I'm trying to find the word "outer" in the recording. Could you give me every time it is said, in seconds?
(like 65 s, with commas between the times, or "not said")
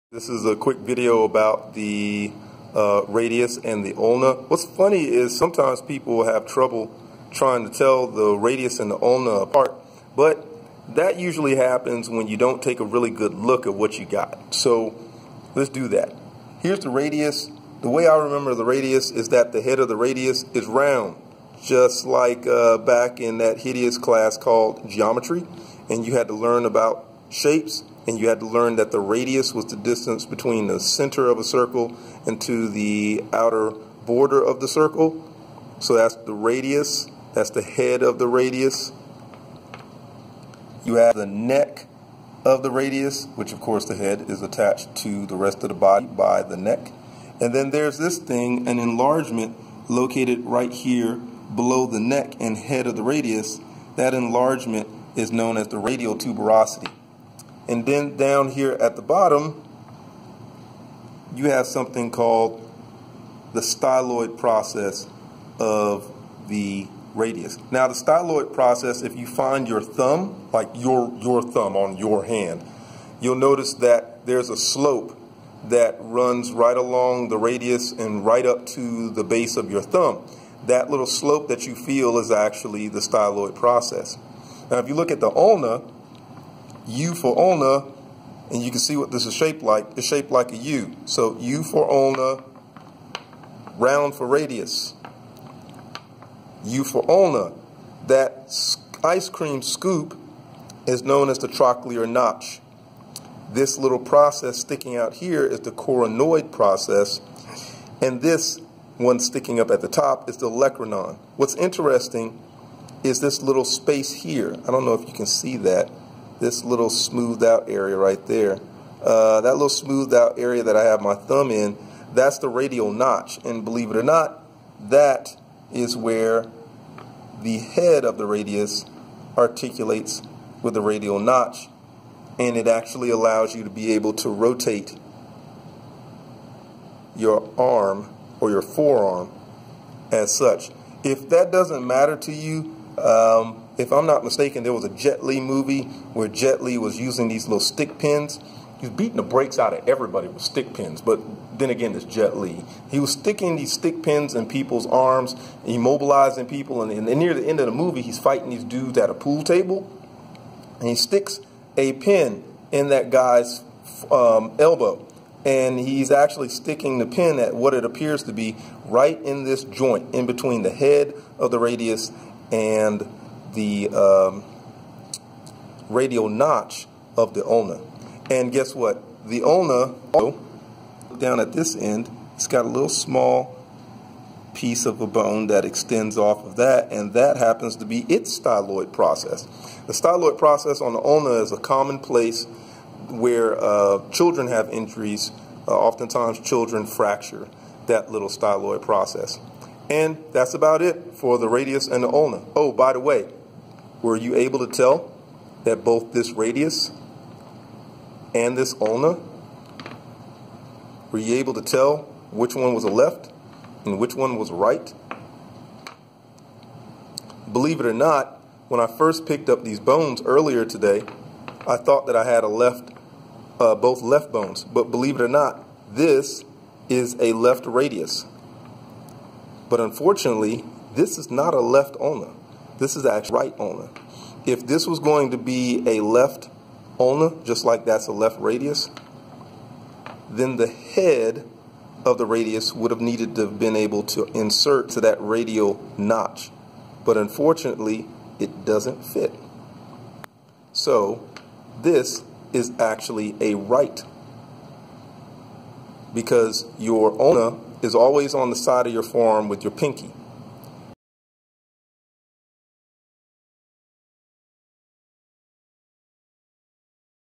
33 s.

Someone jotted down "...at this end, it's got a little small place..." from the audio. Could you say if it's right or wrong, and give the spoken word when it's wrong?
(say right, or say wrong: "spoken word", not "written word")
wrong: "piece", not "place".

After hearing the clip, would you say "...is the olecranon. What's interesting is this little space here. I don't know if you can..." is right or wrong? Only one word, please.
right.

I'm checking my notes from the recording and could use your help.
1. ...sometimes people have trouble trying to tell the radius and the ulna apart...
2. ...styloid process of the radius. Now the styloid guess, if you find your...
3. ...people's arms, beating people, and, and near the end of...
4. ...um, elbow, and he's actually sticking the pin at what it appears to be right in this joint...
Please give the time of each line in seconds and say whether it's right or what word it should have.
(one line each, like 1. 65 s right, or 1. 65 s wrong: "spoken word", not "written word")
1. 5 s right
2. 63 s wrong: "process", not "guess"
3. 154 s wrong: "immobilizing", not "beating"
4. 164 s right.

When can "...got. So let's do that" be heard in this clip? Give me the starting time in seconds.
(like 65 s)
14 s.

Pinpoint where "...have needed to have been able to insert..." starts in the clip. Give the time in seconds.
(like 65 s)
242 s.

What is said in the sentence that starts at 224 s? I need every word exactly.
But believe it or not, this is a left radius.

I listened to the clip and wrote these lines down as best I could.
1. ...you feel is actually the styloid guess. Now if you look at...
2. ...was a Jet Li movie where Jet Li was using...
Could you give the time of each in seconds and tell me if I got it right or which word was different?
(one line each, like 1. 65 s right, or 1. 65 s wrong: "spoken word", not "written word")
1. 81 s wrong: "process", not "guess"
2. 144 s right.